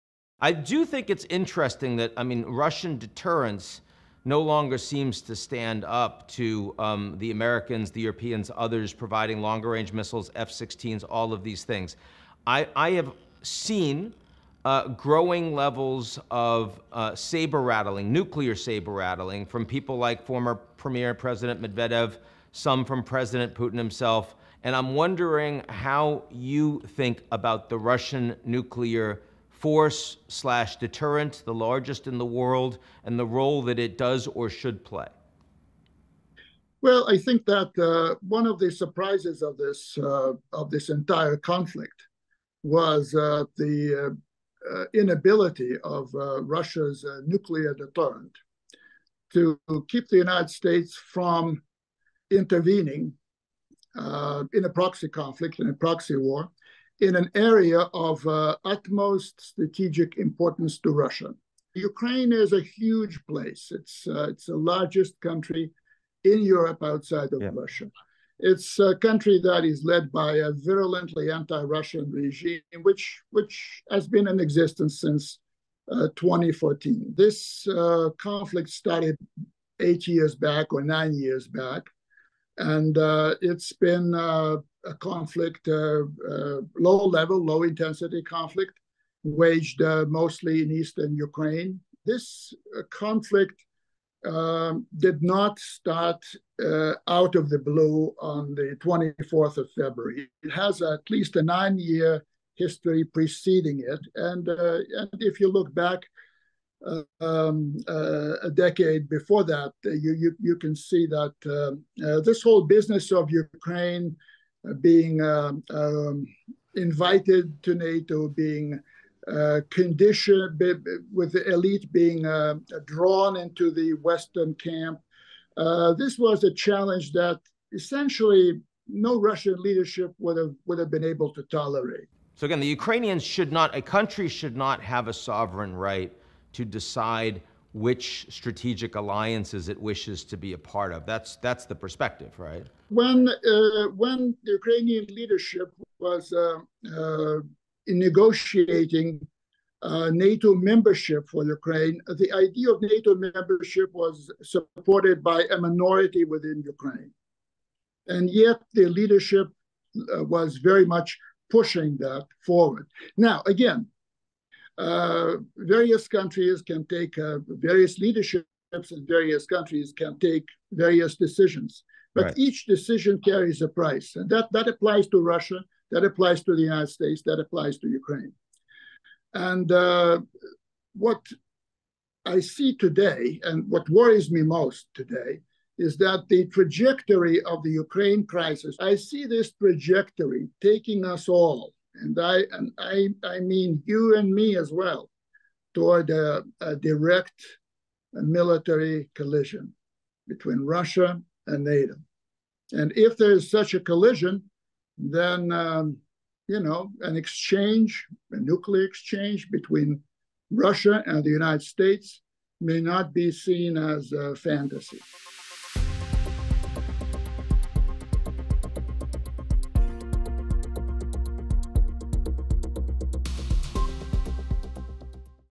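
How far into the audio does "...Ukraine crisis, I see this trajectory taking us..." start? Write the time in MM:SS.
03:07.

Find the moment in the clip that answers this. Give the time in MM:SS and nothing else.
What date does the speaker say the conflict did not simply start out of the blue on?
01:38.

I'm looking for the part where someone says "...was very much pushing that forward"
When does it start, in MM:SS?
02:40.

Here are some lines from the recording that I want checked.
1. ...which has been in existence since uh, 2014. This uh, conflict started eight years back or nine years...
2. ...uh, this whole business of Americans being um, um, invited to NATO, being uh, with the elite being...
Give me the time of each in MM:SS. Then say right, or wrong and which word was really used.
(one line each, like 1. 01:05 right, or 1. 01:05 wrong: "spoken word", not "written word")
1. 01:13 right
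2. 01:52 wrong: "Ukraine", not "Americans".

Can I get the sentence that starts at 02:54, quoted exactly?
And that, that applies to Russia, that applies to the United States, that applies to Ukraine.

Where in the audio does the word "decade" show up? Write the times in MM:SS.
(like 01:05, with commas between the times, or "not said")
01:48.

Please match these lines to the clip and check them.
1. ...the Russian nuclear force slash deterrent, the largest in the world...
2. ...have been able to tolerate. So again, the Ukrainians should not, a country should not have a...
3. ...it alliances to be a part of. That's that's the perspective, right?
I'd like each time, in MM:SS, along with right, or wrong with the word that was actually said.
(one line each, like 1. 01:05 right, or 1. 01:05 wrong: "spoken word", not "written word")
1. 00:27 right
2. 02:10 right
3. 02:19 wrong: "wishes", not "alliances".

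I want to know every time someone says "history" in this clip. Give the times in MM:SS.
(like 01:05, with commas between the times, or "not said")
01:42.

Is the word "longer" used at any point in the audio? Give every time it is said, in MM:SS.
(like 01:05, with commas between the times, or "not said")
00:04, 00:09.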